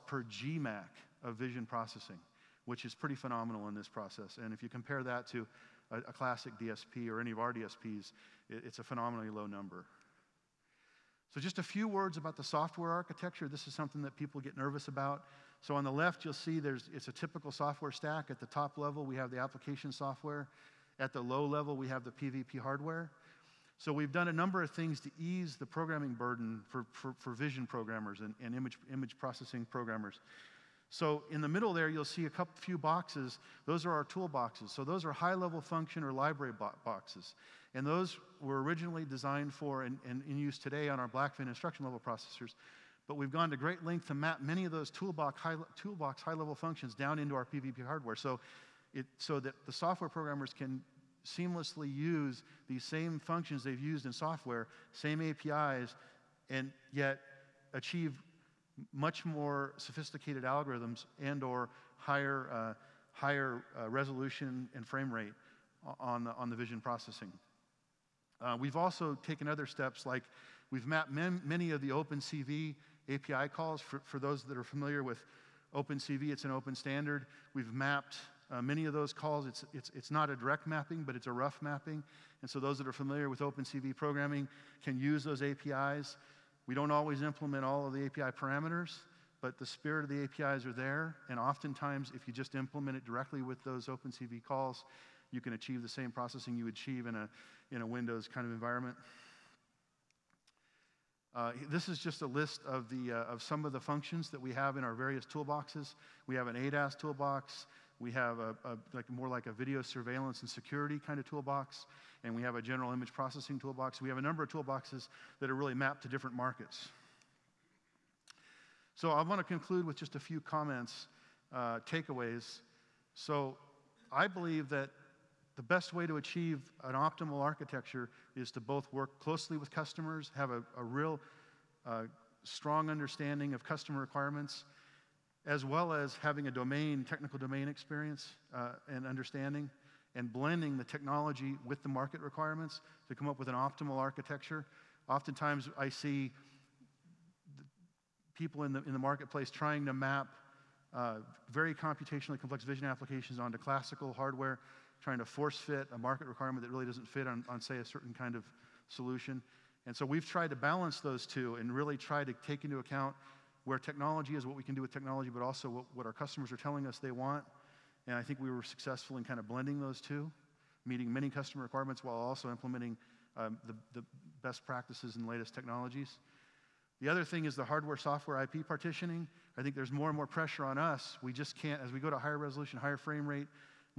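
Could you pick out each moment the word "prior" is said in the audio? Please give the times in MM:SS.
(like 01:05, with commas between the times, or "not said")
not said.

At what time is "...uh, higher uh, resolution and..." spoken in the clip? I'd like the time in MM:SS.
01:02.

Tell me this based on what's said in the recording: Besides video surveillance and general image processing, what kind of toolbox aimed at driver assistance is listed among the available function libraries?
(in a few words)
ADAS toolbox.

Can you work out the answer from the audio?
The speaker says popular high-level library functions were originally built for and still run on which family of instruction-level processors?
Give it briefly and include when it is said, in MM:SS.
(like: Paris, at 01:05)
Blackfin, at 00:41.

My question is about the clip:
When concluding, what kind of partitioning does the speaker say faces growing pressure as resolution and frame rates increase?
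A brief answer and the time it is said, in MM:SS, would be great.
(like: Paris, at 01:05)
hardware software IP partitioning, at 02:57.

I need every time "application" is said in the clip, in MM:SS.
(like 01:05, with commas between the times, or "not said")
00:19, 02:32.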